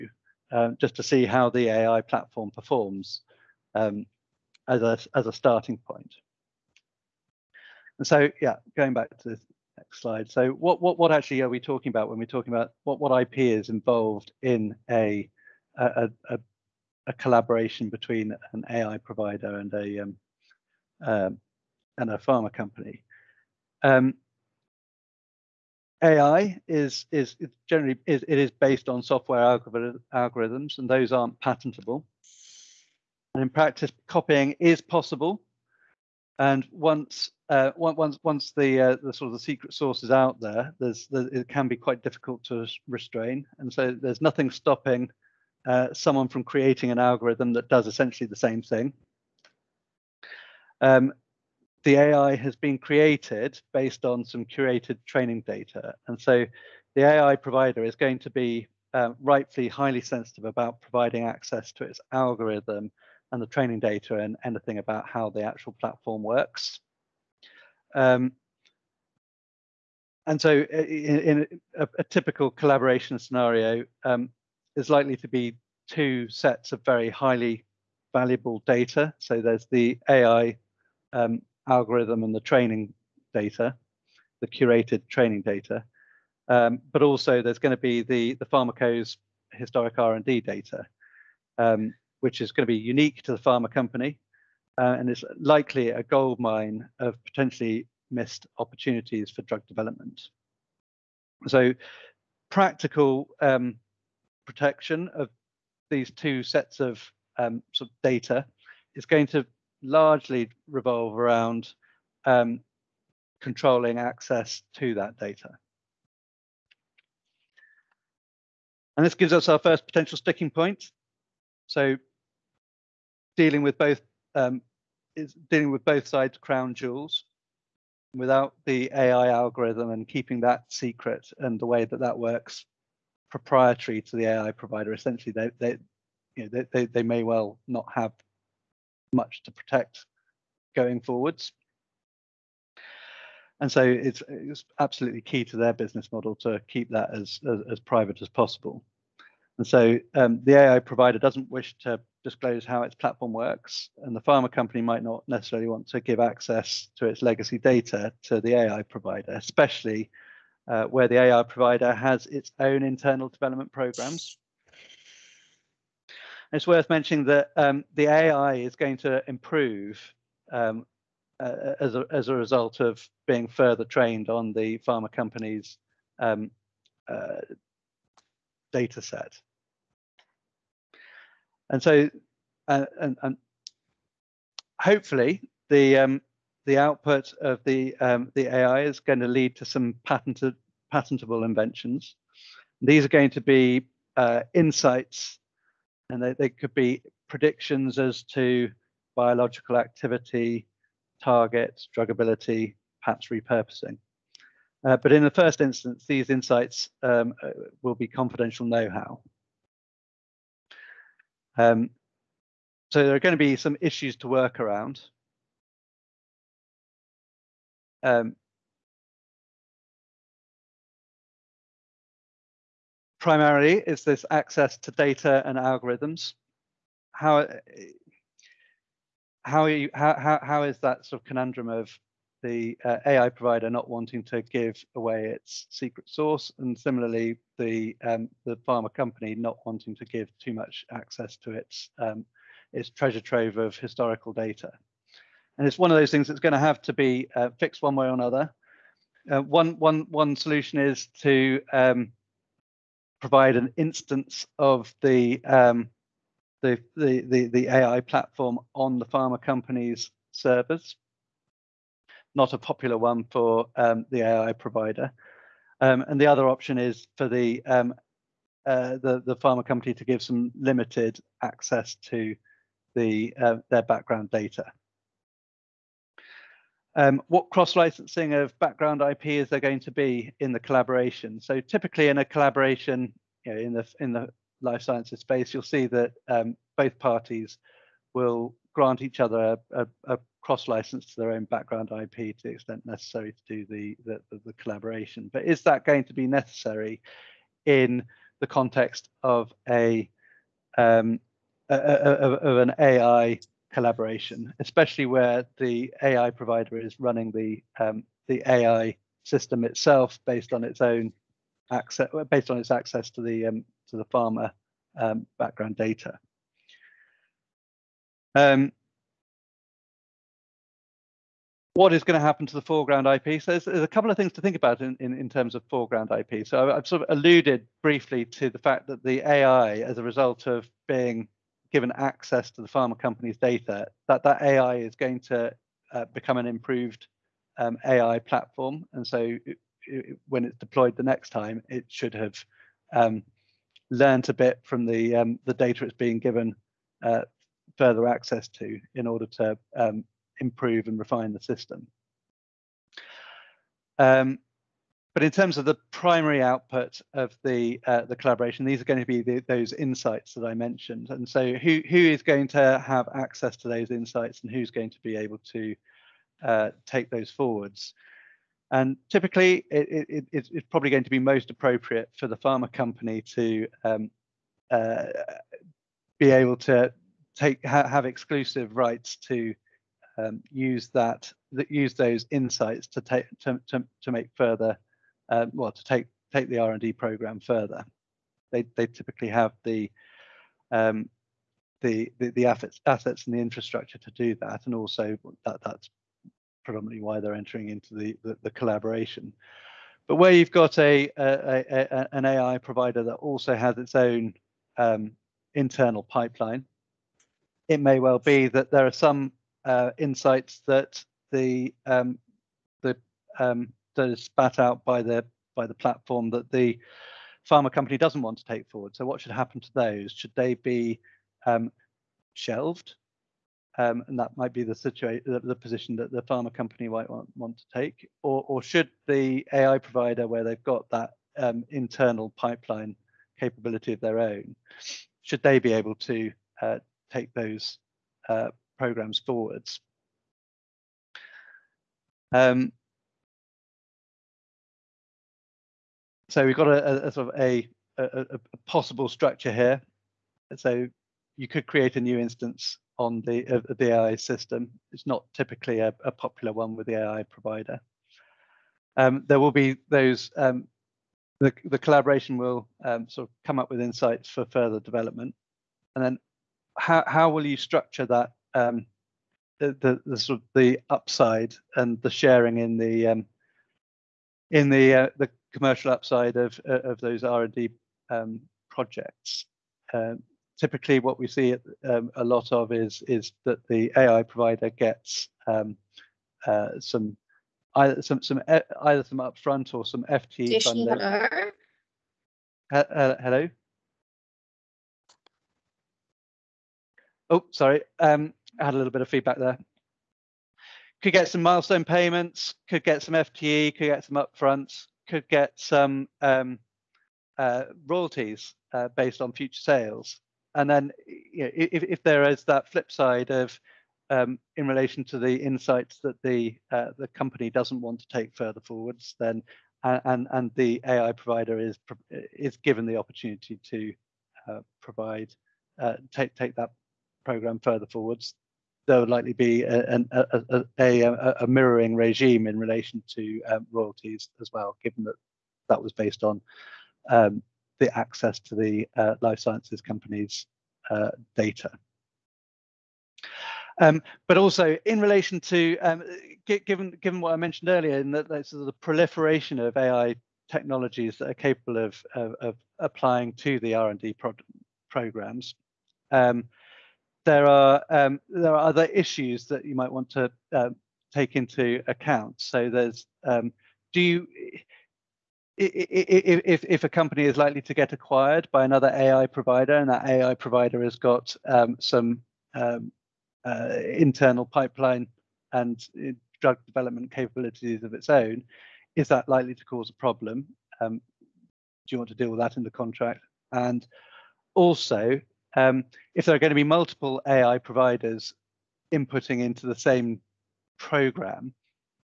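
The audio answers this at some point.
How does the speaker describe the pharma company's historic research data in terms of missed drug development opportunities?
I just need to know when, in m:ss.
1:35.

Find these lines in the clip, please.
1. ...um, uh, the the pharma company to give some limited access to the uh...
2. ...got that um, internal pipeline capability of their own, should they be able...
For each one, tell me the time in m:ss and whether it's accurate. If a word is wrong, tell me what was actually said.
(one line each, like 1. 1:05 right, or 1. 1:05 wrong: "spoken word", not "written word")
1. 4:27 right
2. 7:10 right.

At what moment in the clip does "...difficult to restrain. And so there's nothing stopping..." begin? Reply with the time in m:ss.
0:42.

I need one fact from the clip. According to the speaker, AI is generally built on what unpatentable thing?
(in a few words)
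software algorithms.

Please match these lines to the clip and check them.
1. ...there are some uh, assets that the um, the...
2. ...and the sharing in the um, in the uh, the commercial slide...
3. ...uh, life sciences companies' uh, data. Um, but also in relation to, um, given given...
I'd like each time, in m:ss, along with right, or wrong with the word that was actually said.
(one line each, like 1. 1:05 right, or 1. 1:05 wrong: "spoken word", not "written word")
1. 6:48 wrong: "insights", not "assets"
2. 7:51 wrong: "upside", not "slide"
3. 8:58 right.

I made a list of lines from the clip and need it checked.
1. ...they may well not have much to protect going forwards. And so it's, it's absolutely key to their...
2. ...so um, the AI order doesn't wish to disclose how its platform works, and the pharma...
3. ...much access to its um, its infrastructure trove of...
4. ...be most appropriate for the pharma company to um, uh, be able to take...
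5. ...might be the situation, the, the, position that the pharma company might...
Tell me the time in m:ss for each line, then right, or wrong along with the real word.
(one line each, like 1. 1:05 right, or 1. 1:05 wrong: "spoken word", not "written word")
1. 2:16 right
2. 2:29 wrong: "provider", not "order"
3. 4:00 wrong: "treasure", not "infrastructure"
4. 6:11 right
5. 7:04 right.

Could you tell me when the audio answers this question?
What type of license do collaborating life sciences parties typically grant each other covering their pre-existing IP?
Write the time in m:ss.
4:50.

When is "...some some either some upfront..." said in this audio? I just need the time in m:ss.
8:08.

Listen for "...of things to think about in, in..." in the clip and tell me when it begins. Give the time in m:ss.
5:24.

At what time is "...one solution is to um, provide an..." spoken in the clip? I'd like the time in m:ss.
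4:10.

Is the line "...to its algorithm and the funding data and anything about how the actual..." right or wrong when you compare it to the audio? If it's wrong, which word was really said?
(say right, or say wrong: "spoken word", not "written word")
wrong: "training", not "funding".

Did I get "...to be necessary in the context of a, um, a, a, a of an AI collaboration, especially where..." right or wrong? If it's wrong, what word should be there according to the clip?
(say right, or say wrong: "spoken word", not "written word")
right.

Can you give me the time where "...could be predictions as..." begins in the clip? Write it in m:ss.
3:16.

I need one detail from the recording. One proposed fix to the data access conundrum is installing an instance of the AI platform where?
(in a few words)
on the pharma company's servers.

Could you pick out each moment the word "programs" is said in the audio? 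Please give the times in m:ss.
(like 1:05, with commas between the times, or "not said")
2:43, 6:26, 7:18, 8:47, 9:14, 9:50.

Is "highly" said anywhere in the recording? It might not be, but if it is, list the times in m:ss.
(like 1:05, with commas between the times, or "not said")
0:59, 1:17.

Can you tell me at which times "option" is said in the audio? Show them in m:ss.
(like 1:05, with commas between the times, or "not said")
4:26.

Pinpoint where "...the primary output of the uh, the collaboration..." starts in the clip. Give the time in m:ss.
5:55.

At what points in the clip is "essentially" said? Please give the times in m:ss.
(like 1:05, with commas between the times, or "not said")
0:47, 2:14.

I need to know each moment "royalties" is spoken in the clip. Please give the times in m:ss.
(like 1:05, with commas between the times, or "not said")
8:27, 8:53.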